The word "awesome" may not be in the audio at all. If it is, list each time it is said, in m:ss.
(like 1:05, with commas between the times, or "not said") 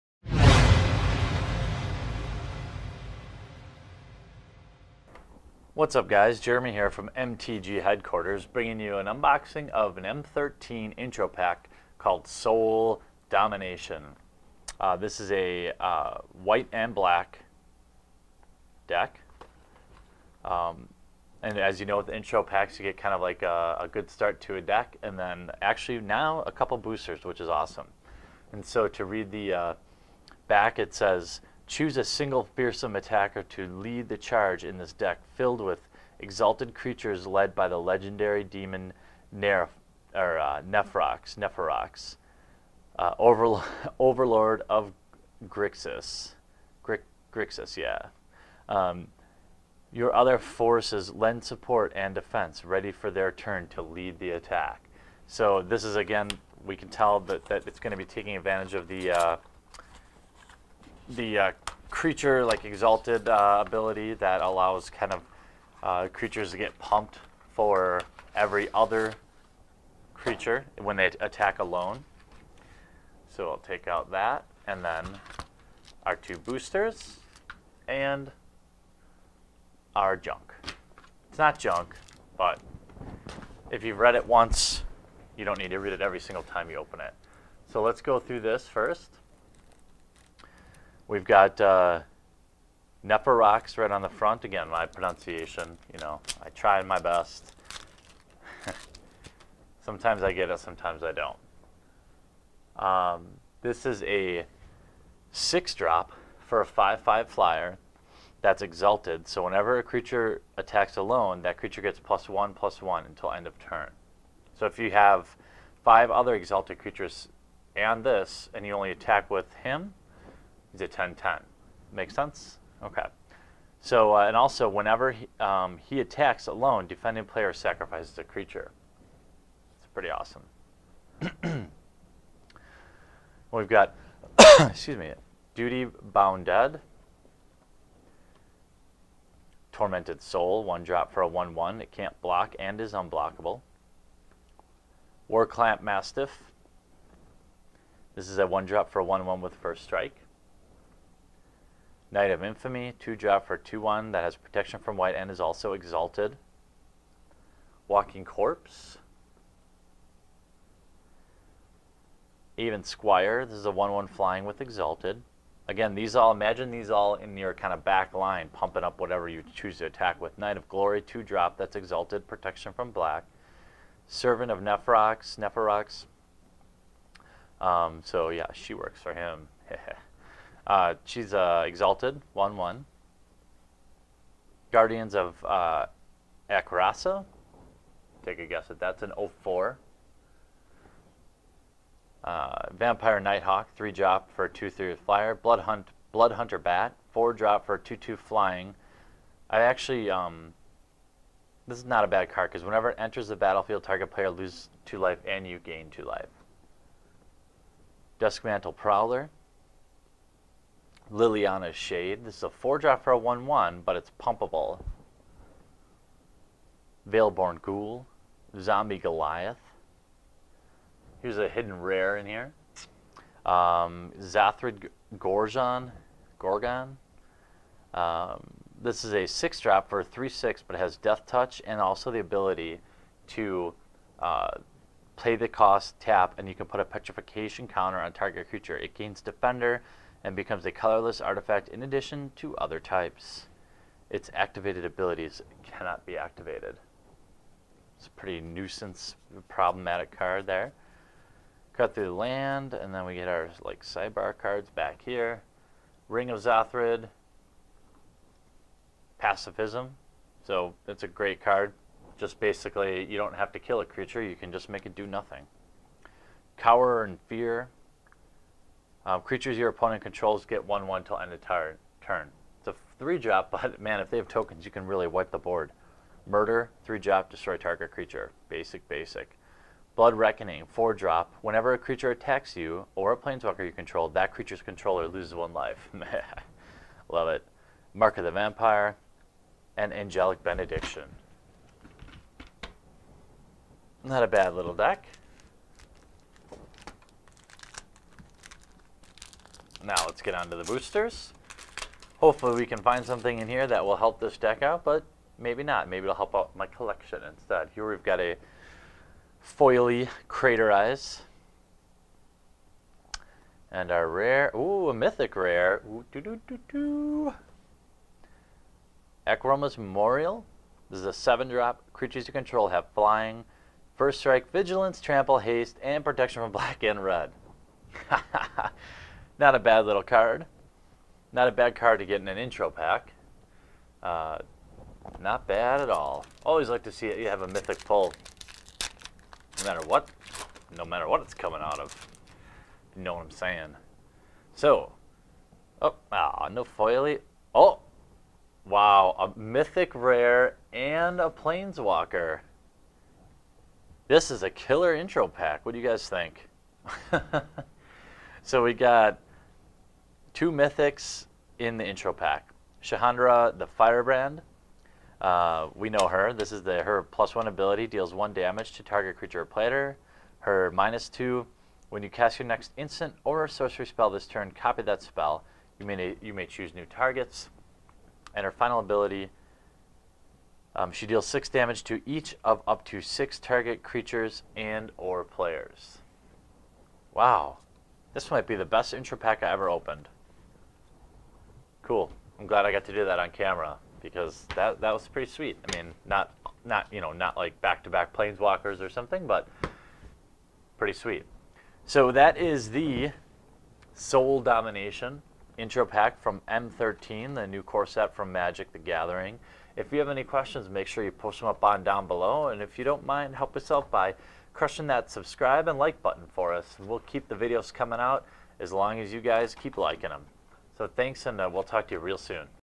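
0:27, 2:10.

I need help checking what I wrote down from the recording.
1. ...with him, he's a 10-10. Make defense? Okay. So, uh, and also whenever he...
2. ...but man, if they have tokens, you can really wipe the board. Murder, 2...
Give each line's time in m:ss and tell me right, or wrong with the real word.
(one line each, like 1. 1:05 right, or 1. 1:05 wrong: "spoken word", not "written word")
1. 1:59 wrong: "sense", not "defense"
2. 4:33 wrong: "3", not "2".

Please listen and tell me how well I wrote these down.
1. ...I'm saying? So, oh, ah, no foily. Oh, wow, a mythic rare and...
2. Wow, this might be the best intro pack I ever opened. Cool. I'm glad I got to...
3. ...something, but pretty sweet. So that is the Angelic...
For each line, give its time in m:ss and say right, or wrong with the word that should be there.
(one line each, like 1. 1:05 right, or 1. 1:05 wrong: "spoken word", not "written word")
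1. 5:43 right
2. 6:27 right
3. 6:38 wrong: "Sole", not "Angelic".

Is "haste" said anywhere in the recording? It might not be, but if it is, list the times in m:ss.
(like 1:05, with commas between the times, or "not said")
5:25.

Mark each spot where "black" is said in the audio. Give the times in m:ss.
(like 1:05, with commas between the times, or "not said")
0:16, 2:52, 5:26.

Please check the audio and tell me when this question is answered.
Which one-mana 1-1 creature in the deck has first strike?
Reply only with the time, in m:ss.
2:25.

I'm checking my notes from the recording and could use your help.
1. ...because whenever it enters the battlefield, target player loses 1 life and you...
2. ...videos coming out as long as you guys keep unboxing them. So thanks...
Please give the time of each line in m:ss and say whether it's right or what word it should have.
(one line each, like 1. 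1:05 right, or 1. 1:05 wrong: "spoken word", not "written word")
1. 3:22 wrong: "2", not "1"
2. 6:57 wrong: "liking", not "unboxing".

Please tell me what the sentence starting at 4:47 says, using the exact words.
Mark of the Vampire, and Angelic Benediction.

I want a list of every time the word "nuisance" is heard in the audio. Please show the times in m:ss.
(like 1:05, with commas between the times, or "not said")
4:08.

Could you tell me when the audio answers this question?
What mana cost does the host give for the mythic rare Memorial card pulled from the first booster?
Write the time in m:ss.
5:21.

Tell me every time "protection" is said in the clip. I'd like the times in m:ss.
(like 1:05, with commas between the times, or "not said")
2:34, 2:52, 5:26.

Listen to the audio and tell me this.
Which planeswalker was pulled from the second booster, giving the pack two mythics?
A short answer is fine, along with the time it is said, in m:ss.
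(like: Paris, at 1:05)
Chandra the Firebrand, at 6:02.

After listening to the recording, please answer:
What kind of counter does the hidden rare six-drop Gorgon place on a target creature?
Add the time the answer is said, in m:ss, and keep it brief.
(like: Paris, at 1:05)
Petrification counter, at 3:56.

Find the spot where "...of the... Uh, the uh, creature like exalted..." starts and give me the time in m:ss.
0:58.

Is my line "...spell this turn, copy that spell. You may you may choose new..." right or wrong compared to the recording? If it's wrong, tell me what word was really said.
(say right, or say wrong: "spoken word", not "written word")
right.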